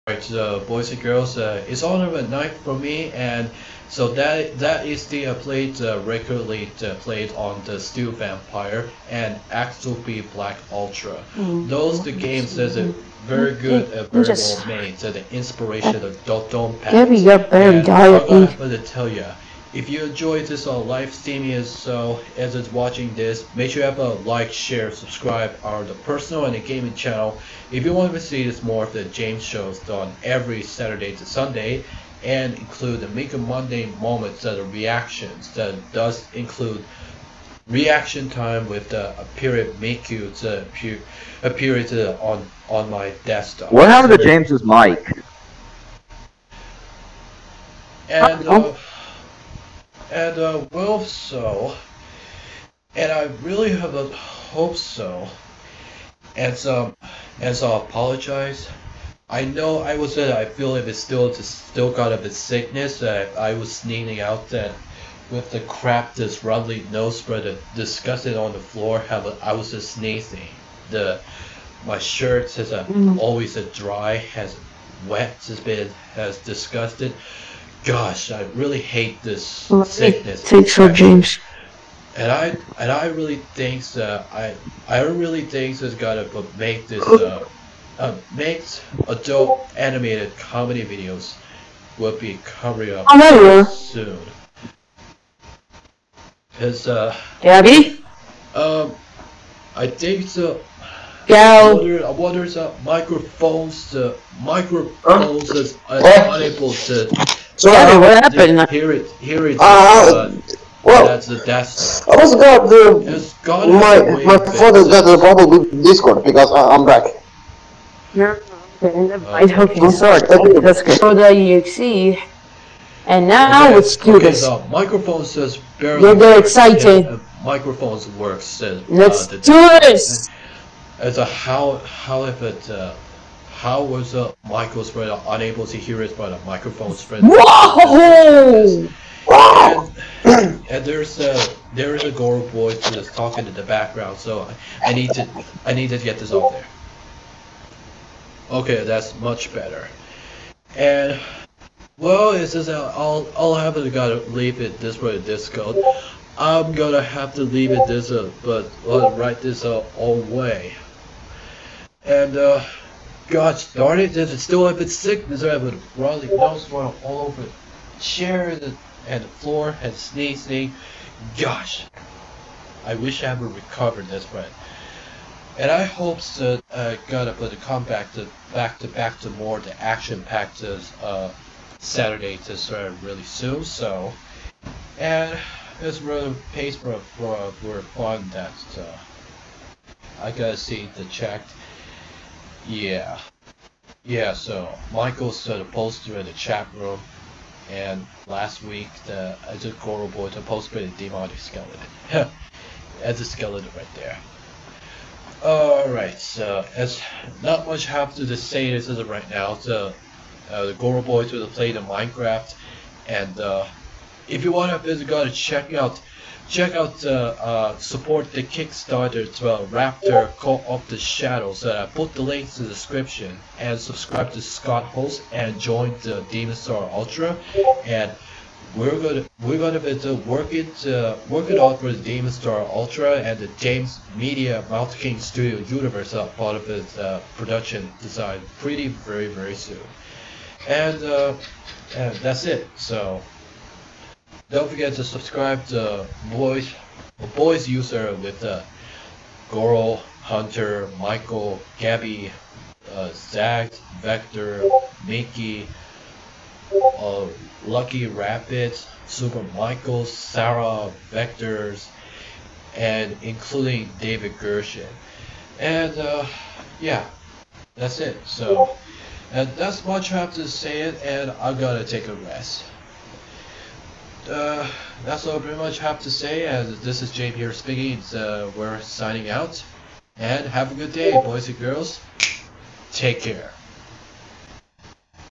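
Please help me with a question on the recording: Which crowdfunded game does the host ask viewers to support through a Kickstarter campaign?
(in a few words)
Raptor Call of the Shadows.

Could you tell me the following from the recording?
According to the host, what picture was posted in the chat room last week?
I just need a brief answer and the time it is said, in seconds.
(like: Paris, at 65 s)
demonic skeleton, at 201 s.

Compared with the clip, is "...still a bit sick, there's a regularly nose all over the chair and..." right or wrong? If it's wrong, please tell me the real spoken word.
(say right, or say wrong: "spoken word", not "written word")
wrong: "broadly", not "regularly".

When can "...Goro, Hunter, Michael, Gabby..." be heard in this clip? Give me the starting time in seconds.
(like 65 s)
249 s.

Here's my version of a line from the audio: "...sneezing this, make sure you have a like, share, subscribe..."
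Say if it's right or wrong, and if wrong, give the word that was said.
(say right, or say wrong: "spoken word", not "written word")
wrong: "watching", not "sneezing".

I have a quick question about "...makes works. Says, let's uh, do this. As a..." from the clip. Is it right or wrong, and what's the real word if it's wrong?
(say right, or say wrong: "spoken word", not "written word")
wrong: "microphones", not "makes".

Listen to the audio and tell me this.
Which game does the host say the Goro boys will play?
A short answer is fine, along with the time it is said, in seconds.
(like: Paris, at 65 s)
Minecraft, at 211 s.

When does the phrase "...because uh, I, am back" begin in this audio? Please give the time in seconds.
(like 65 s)
116 s.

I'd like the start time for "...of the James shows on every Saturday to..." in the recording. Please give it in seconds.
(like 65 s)
28 s.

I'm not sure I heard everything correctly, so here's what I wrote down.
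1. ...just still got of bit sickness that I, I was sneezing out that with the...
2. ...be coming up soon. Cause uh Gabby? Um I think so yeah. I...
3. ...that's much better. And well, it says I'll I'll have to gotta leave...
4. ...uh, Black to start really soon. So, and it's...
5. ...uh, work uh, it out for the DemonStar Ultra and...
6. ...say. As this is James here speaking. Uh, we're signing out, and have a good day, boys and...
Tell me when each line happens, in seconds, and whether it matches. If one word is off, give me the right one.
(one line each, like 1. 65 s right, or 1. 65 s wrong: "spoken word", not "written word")
1. 61 s right
2. 92 s right
3. 148 s right
4. 181 s wrong: "Saturday", not "Black"
5. 230 s right
6. 276 s right.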